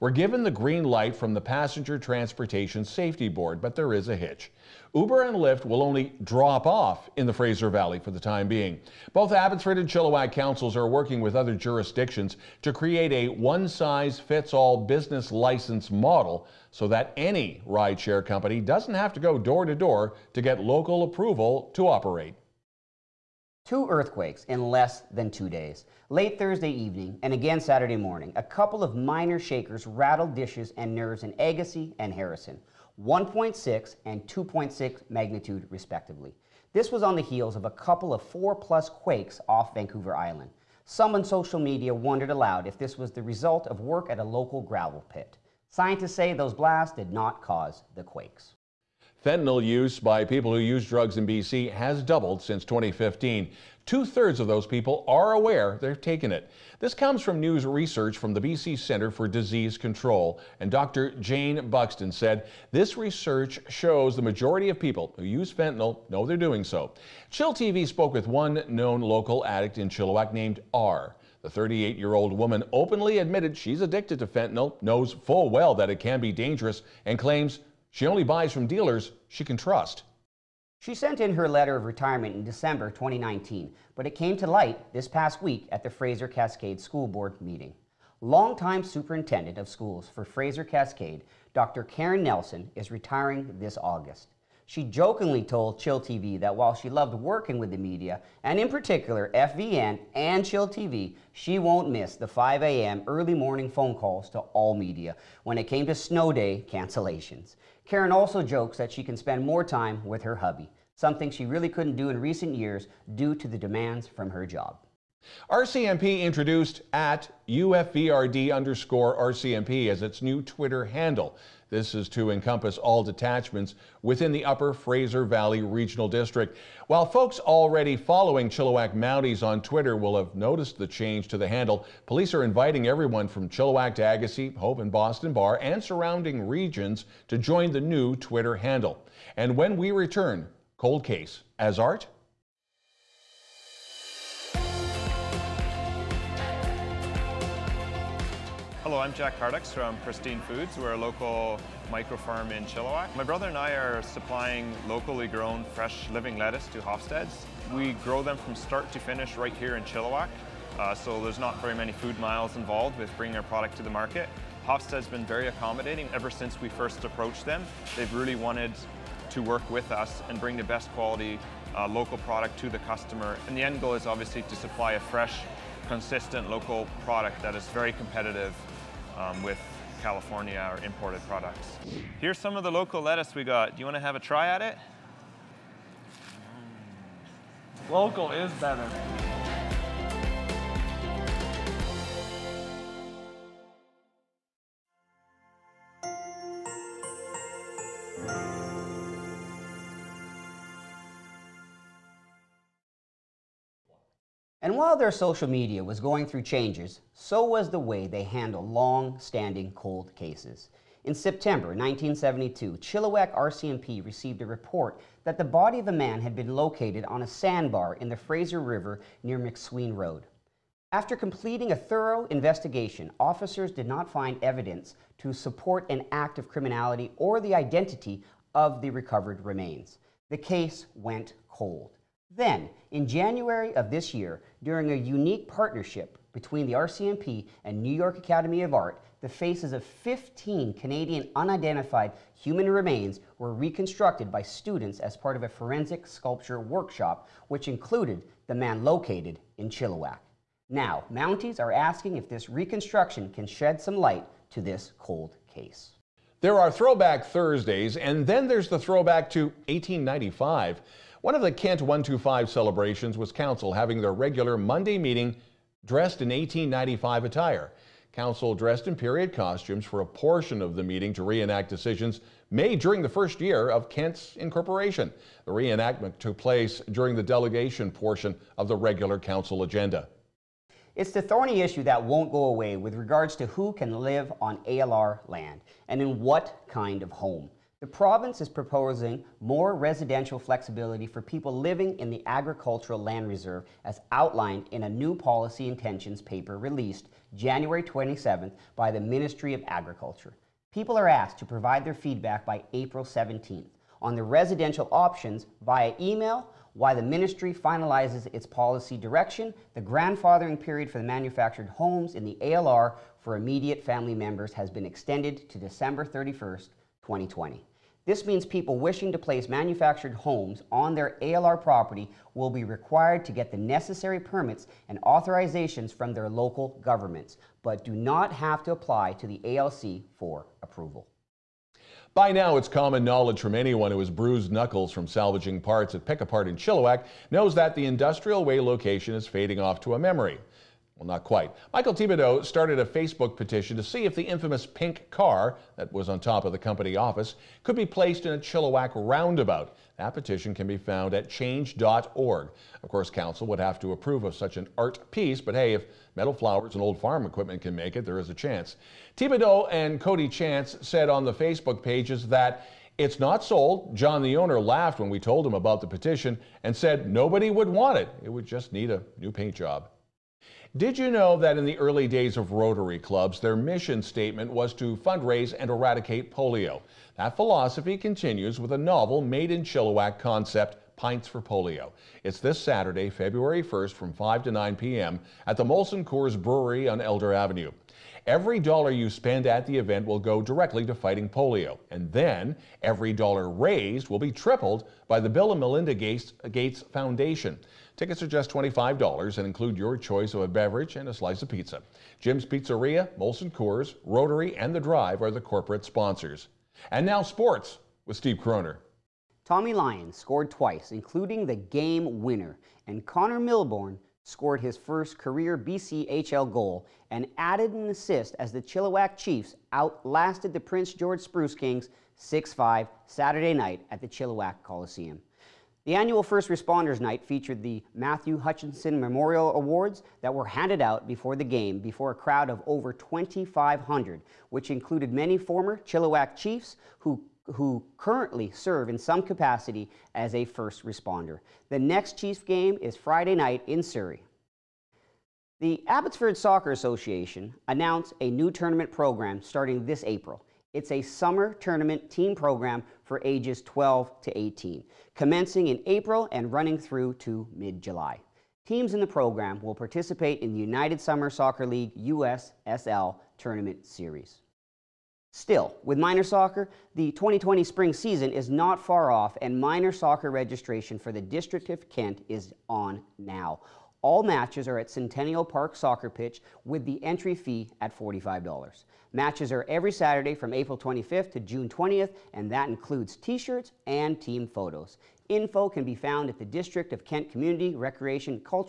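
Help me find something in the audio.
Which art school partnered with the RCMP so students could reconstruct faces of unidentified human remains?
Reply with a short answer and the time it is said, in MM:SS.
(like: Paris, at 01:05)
New York Academy of Art, at 03:57.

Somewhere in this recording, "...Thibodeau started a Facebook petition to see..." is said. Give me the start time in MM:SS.
05:41.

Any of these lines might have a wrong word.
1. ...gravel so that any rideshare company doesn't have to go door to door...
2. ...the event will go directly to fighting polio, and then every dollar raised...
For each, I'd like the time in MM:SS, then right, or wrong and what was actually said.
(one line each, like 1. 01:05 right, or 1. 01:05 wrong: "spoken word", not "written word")
1. 00:15 wrong: "model", not "gravel"
2. 06:29 right.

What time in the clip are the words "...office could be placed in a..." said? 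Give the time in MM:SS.
05:46.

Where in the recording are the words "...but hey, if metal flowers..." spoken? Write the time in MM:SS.
05:55.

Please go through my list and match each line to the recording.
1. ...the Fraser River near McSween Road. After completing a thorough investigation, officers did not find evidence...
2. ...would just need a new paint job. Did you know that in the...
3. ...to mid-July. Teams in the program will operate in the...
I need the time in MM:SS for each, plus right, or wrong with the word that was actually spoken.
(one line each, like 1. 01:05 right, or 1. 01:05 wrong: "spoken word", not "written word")
1. 03:38 right
2. 06:08 right
3. 07:37 wrong: "participate", not "operate".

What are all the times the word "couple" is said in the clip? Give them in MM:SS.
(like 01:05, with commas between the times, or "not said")
00:28, 00:37.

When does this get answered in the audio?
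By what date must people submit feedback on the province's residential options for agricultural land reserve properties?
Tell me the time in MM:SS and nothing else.
05:02.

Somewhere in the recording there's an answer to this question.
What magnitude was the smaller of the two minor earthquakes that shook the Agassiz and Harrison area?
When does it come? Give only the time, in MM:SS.
00:33.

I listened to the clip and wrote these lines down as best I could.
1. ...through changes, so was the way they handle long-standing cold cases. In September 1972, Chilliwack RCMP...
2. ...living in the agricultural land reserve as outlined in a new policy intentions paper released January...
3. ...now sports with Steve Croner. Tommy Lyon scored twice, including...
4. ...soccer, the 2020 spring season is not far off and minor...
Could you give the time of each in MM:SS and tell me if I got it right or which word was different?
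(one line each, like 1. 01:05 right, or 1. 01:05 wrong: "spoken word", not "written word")
1. 03:26 right
2. 04:51 right
3. 06:47 right
4. 07:46 right.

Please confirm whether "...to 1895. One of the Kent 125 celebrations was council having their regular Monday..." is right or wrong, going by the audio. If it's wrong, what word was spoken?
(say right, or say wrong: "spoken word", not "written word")
right.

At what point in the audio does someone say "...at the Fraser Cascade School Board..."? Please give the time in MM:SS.
01:25.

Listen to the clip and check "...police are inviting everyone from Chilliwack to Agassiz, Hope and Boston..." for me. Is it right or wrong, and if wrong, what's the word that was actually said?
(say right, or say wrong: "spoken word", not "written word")
right.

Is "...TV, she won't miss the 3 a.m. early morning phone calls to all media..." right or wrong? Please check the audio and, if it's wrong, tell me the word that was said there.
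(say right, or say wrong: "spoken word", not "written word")
wrong: "5", not "3".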